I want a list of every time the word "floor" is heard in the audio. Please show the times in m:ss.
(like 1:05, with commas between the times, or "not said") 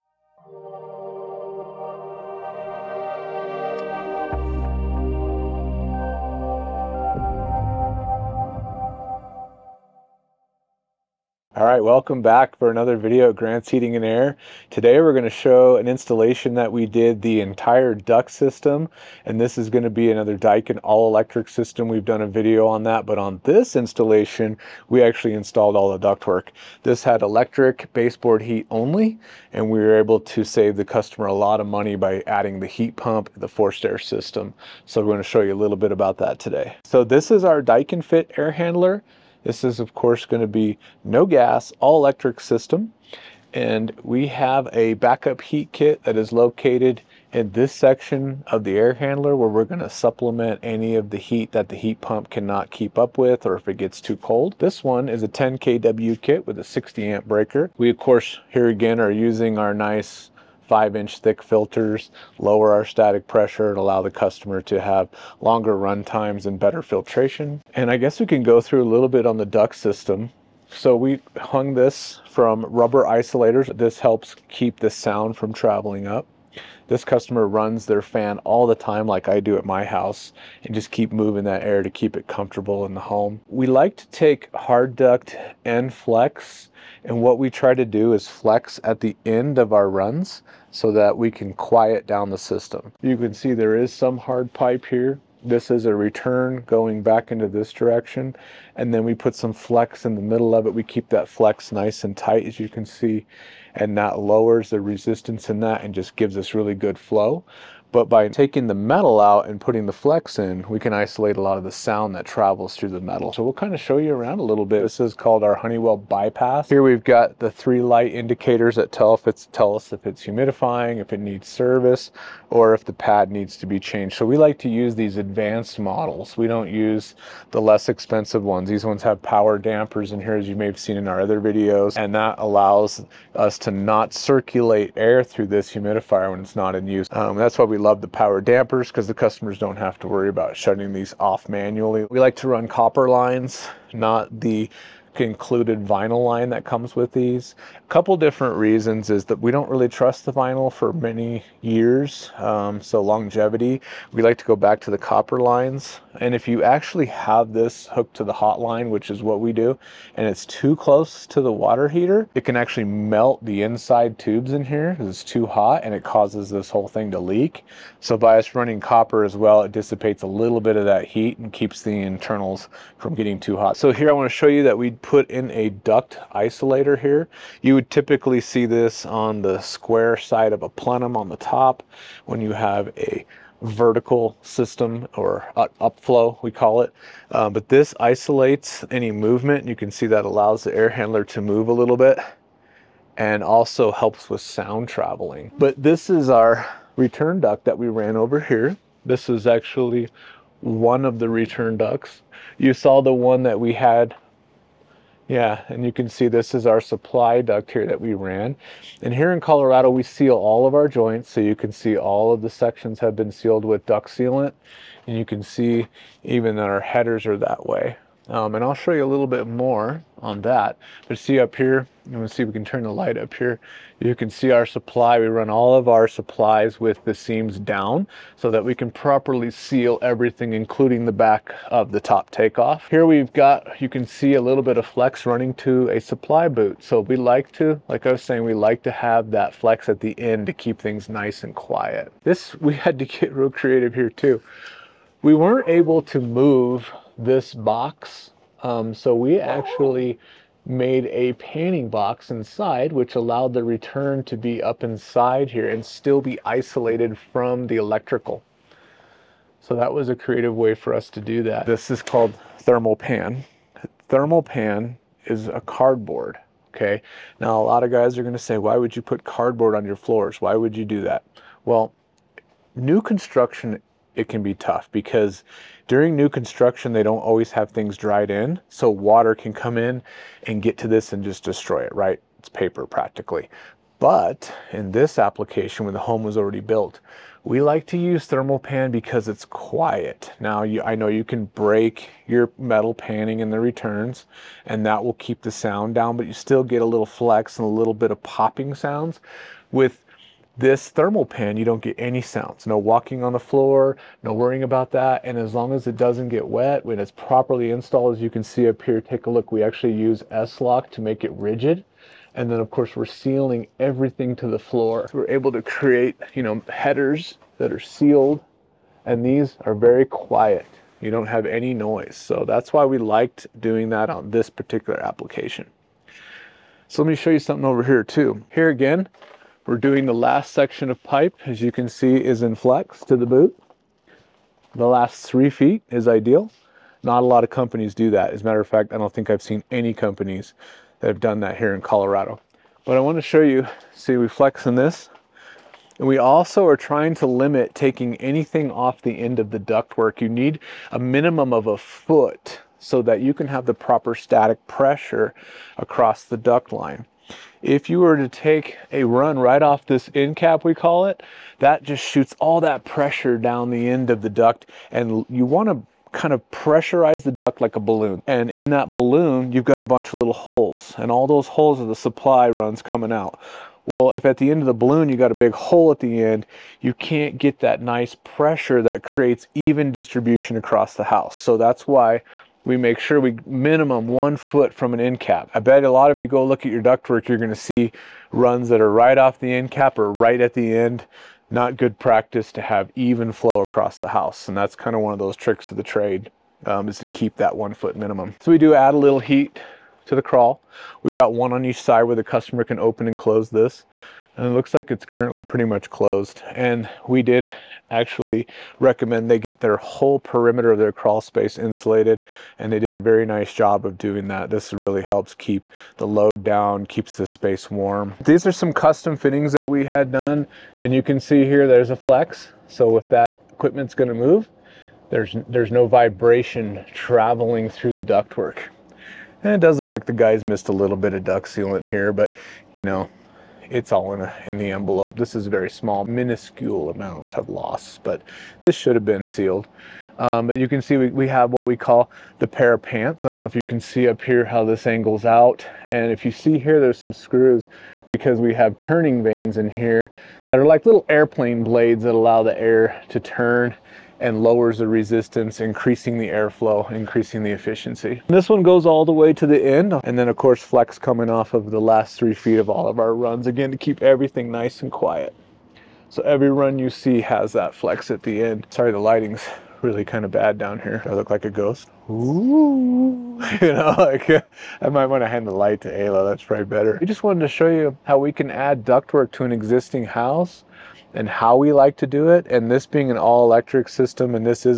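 4:29, 5:03, 5:14.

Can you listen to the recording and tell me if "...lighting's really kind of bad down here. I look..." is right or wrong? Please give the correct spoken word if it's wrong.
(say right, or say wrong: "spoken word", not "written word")
right.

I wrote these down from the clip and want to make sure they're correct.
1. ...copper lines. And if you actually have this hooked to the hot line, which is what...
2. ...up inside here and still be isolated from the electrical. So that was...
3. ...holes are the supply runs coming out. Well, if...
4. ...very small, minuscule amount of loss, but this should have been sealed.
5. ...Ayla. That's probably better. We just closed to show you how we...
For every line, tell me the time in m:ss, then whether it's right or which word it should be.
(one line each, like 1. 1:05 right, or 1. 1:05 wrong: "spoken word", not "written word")
1. 2:34 right
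2. 4:14 right
3. 6:11 right
4. 7:15 right
5. 7:55 wrong: "wanted", not "closed".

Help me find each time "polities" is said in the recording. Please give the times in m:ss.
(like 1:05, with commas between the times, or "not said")
not said.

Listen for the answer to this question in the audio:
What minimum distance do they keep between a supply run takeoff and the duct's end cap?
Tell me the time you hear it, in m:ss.
6:23.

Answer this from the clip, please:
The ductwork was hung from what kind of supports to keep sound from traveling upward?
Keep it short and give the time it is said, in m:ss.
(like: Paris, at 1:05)
Rubber isolators, at 1:12.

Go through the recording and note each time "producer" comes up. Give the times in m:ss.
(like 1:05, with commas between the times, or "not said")
not said.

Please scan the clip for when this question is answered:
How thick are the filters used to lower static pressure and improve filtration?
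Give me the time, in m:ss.
1:00.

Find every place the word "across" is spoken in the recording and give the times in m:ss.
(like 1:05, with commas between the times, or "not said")
5:55, 6:20, 6:33.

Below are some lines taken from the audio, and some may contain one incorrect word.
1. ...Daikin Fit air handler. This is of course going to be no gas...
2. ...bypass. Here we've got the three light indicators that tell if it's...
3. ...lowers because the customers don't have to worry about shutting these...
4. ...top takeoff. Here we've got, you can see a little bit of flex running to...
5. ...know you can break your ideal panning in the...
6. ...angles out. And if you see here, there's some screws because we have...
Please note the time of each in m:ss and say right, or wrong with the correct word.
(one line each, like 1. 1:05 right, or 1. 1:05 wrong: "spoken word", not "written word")
1. 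0:37 right
2. 1:55 right
3. 2:18 wrong: "dampers", not "lowers"
4. 3:52 right
5. 4:50 wrong: "metal", not "ideal"
6. 7:24 right.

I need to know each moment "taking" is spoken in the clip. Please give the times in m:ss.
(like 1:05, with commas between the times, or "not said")
1:48, 5:47.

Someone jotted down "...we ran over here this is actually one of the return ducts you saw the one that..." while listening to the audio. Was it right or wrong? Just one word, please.
right.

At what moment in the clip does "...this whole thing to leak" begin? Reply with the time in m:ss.
2:46.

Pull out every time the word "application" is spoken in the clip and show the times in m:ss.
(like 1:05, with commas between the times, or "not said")
4:45, 5:25.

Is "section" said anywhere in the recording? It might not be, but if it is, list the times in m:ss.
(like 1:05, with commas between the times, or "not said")
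0:47, 3:32, 5:30.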